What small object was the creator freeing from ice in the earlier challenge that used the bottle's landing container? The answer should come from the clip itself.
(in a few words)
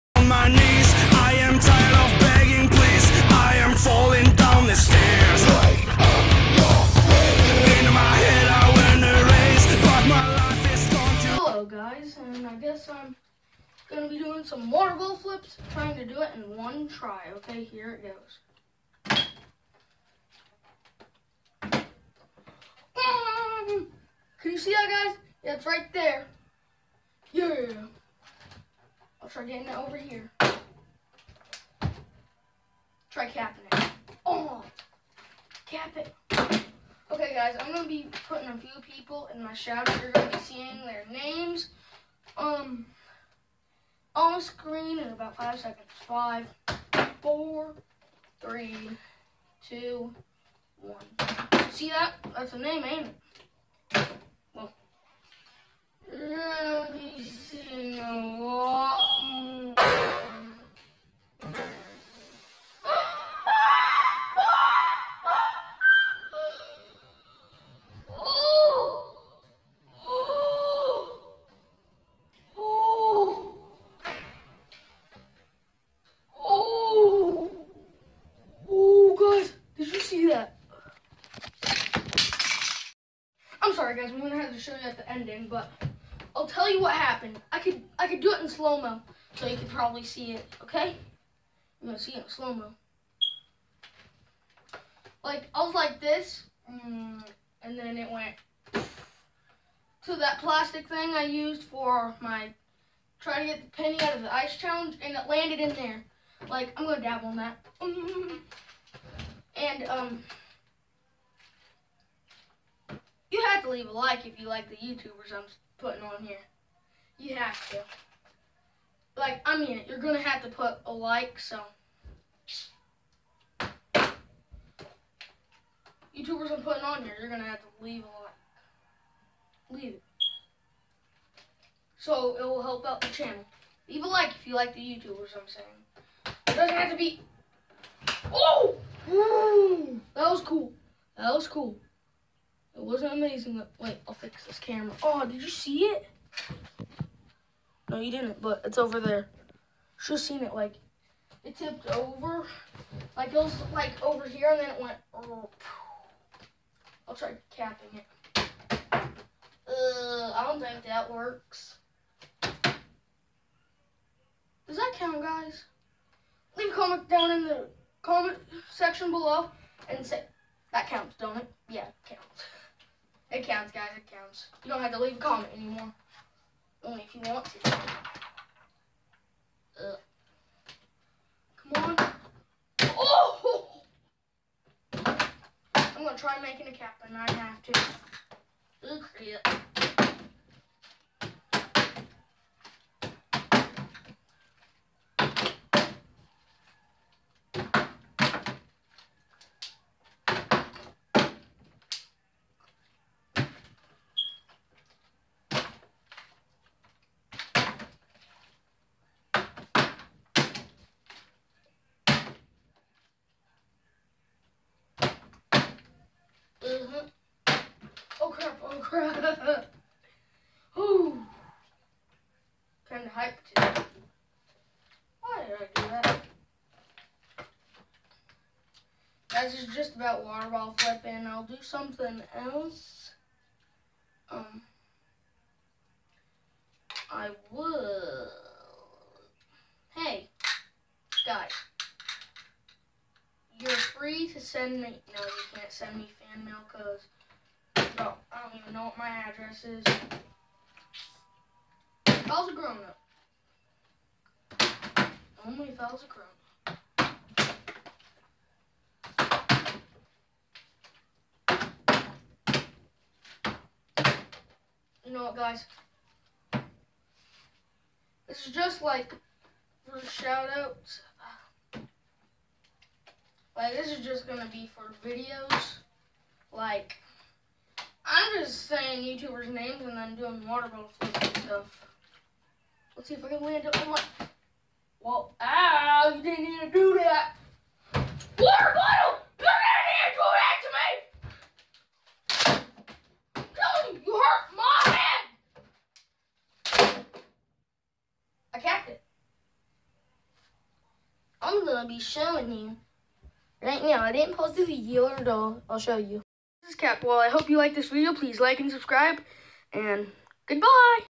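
penny.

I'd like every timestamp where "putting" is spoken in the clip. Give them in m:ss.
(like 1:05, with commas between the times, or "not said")
0:38, 1:55, 2:06.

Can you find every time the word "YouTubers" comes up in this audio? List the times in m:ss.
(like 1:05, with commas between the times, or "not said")
1:54, 2:06, 2:14, 4:39.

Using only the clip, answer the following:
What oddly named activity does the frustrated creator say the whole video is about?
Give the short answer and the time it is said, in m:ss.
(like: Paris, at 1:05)
water ball flipping, at 3:50.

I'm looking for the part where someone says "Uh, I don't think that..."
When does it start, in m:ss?
2:38.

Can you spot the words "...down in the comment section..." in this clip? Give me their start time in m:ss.
2:47.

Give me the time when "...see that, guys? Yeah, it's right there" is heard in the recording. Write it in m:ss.
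0:24.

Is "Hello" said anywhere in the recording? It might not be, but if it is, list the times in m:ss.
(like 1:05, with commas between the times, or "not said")
0:11.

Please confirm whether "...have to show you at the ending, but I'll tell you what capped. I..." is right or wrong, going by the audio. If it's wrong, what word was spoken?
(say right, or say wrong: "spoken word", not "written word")
wrong: "happened", not "capped".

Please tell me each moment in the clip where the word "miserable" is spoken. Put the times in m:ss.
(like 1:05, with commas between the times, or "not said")
not said.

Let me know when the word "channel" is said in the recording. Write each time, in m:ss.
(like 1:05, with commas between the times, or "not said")
2:13.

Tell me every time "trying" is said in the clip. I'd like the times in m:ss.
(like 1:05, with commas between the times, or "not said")
0:15, 1:43.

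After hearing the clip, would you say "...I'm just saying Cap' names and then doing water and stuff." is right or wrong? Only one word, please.
wrong.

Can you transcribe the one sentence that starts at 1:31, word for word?
I'm gonna see it in slow-mo.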